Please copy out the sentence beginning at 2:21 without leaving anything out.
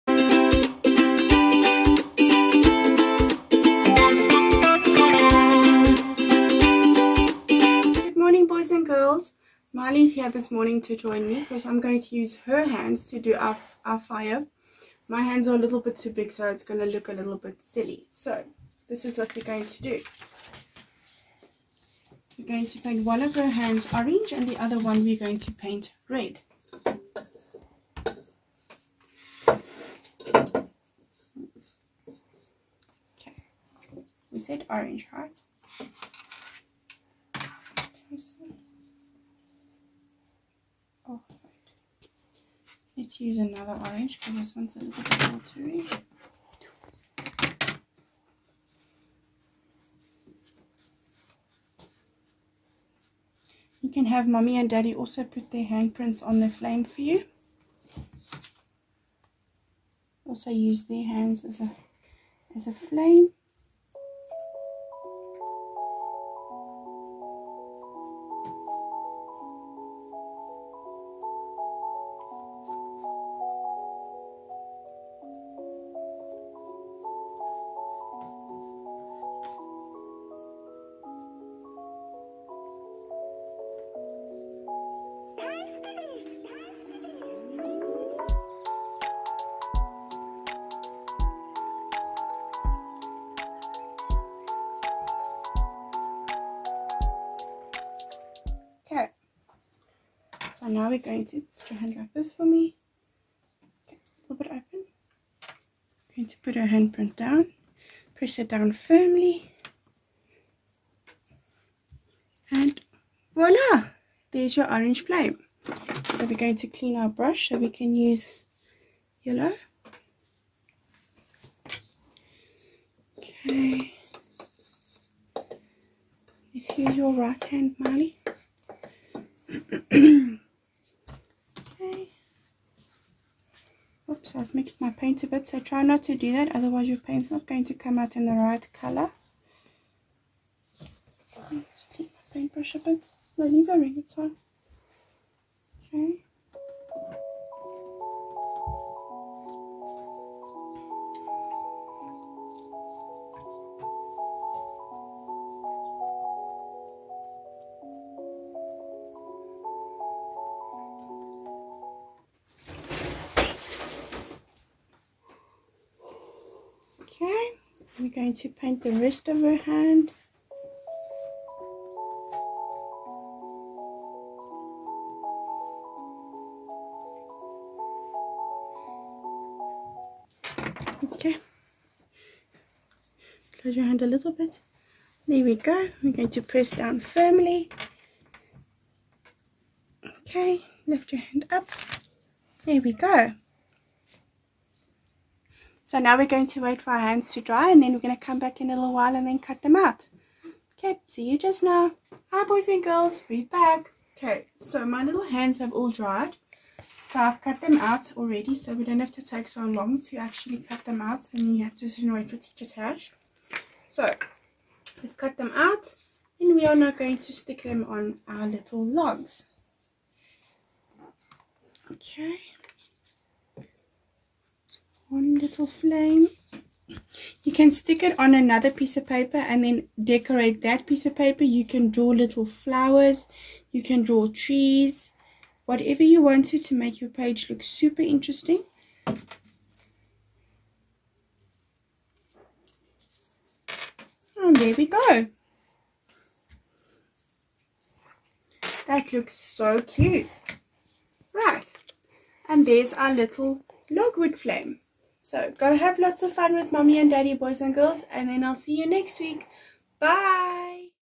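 Just clean my paintbrush a bit.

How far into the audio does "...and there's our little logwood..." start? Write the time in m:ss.
4:12.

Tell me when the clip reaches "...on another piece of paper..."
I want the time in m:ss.
3:48.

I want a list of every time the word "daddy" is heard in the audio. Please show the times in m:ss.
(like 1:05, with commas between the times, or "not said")
0:54, 4:17.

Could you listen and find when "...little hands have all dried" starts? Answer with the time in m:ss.
3:25.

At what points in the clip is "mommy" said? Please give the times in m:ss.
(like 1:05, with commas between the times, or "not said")
0:54, 4:16.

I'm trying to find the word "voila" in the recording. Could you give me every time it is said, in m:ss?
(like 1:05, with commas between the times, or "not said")
1:53.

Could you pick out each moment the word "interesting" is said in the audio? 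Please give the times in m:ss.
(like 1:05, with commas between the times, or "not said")
3:58.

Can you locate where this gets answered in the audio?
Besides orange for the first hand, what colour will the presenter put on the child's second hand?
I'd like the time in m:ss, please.
0:26.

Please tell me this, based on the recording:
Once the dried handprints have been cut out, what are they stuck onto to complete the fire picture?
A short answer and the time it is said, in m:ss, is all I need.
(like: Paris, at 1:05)
logs, at 3:38.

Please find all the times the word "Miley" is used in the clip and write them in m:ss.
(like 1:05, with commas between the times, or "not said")
0:09.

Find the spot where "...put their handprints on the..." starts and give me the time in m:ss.
0:55.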